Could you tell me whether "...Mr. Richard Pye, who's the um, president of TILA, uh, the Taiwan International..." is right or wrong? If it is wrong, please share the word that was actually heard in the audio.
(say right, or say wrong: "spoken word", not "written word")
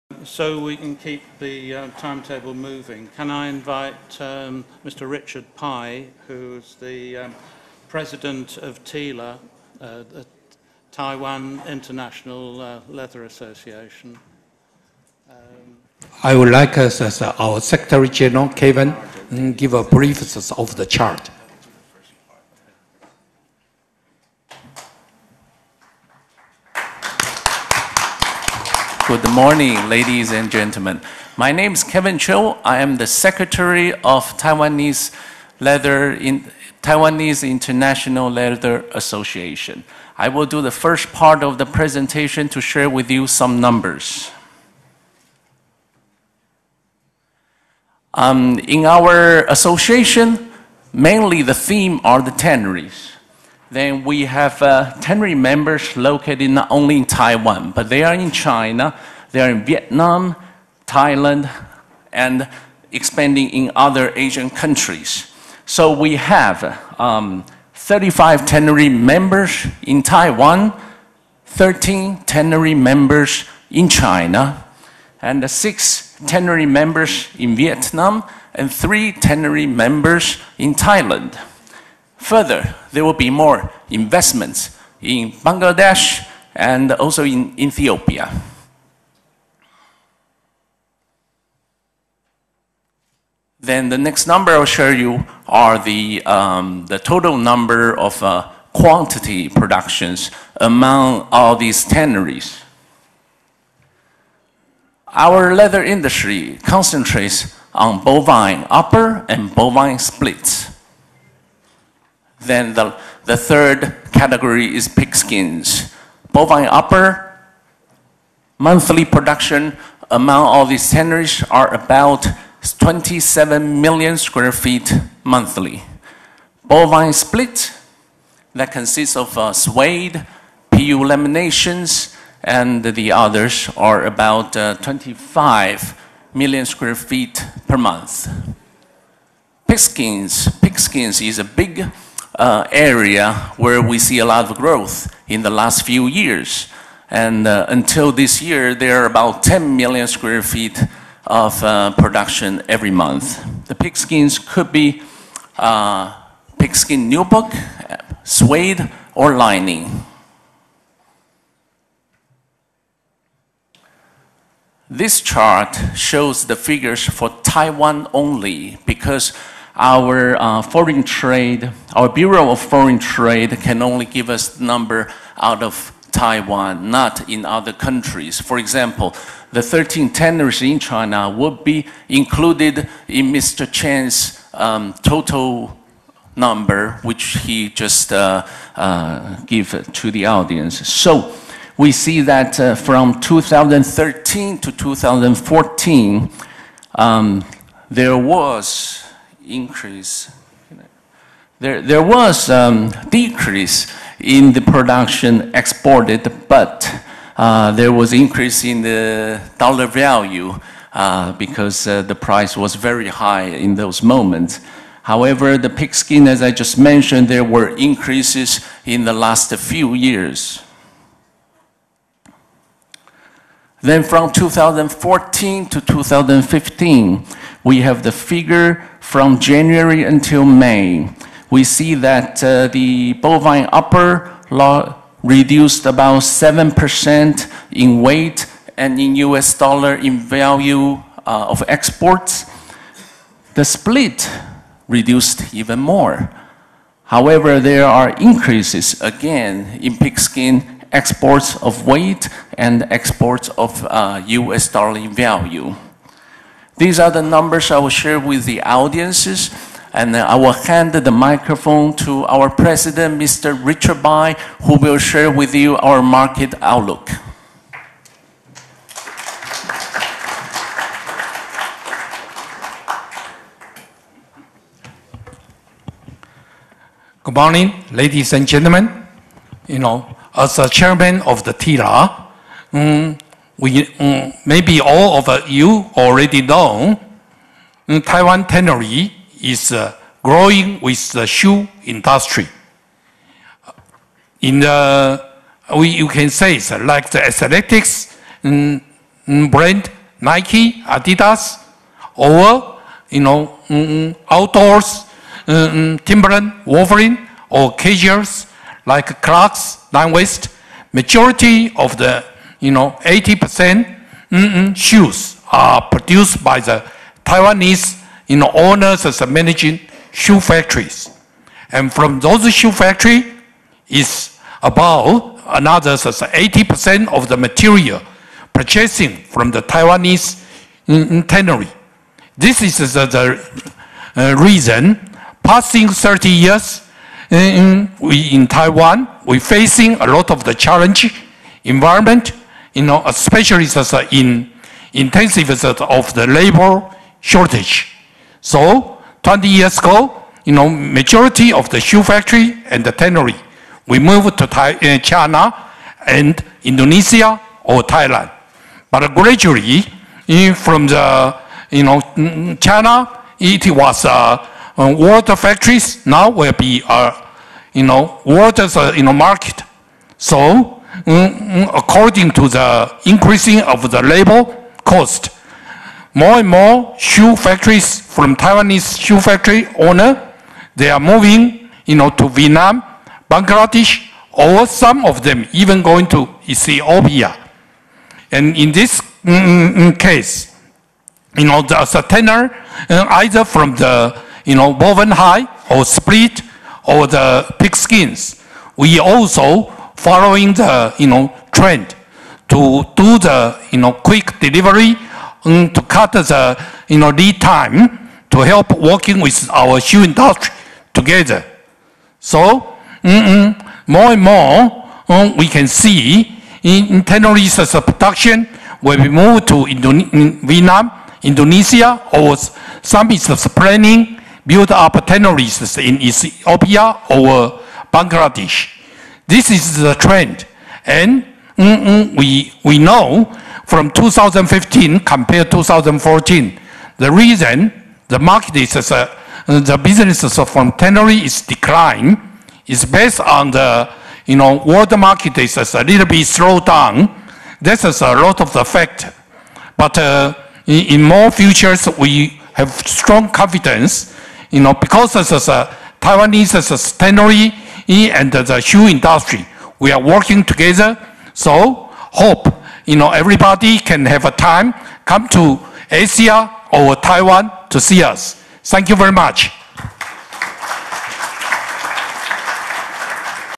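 right.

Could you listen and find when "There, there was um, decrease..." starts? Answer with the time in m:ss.
3:21.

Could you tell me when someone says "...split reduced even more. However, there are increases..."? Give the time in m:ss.
4:03.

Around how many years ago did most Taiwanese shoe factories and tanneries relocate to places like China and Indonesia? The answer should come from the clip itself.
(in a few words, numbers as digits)
20 years.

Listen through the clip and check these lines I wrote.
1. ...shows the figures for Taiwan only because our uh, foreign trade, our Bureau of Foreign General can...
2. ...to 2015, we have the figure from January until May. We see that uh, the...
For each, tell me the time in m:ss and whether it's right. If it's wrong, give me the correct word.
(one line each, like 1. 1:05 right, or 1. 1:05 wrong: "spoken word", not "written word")
1. 2:45 wrong: "Trade", not "General"
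2. 3:45 right.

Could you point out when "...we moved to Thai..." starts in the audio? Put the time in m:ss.
5:53.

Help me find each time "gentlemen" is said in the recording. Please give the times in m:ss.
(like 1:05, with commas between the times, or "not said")
0:30, 4:38.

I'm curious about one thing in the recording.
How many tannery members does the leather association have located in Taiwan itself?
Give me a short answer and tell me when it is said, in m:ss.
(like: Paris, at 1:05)
35, at 1:07.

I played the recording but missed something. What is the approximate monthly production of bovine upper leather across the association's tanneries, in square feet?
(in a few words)
27 million square feet.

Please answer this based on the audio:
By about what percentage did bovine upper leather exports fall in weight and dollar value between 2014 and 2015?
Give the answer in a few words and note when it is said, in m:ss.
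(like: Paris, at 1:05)
7%, at 3:56.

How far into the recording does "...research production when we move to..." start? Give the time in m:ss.
6:57.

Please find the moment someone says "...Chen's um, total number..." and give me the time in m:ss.
3:03.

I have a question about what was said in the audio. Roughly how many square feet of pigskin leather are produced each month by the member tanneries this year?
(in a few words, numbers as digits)
10 million square feet.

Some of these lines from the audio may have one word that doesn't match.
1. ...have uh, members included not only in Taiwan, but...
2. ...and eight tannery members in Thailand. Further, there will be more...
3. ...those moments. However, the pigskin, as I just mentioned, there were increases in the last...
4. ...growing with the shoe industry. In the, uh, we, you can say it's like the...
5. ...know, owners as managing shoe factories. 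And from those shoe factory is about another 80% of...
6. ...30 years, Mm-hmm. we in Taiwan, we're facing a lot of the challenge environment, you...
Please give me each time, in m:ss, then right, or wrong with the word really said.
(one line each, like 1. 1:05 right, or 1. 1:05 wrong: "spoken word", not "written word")
1. 0:54 wrong: "located", not "included"
2. 1:18 wrong: "three", not "eight"
3. 3:33 right
4. 4:50 right
5. 5:18 right
6. 5:35 right.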